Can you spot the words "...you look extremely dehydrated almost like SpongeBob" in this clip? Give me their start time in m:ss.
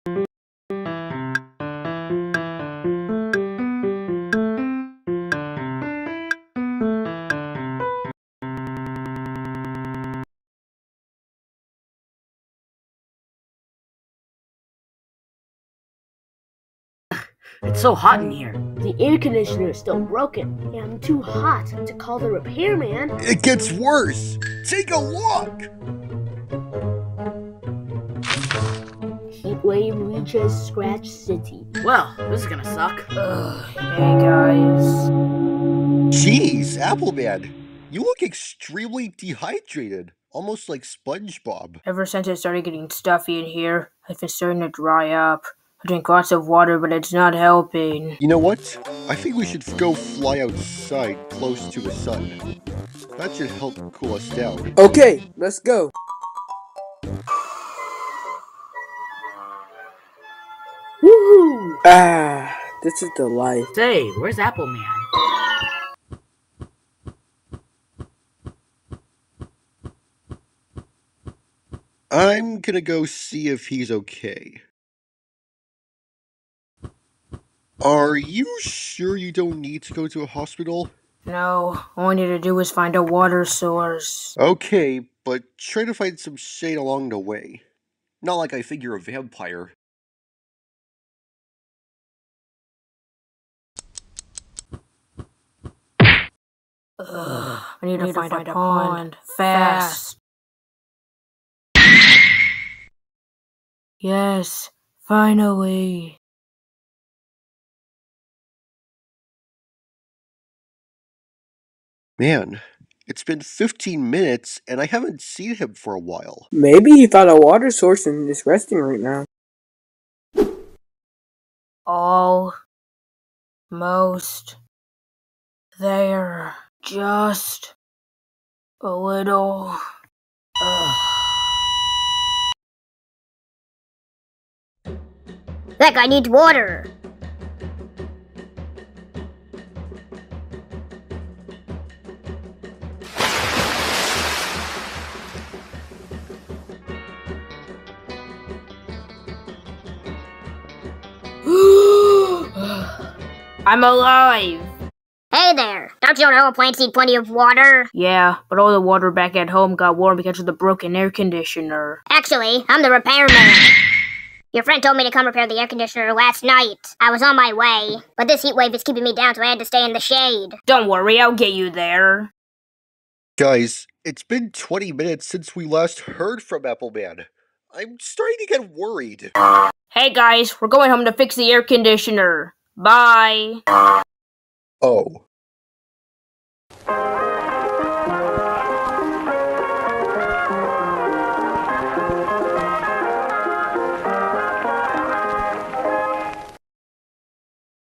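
0:37.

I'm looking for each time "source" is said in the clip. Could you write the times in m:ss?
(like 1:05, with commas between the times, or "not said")
1:23, 1:57.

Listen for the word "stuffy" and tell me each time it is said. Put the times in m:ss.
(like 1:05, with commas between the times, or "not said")
0:42.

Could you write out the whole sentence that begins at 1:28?
Not like I think you're a vampire.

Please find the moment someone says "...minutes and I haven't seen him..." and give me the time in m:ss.
1:54.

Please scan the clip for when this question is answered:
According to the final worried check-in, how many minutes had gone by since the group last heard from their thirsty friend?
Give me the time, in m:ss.
2:54.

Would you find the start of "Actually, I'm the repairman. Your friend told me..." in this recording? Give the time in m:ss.
2:42.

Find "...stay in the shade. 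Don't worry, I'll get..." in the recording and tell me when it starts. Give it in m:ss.
2:49.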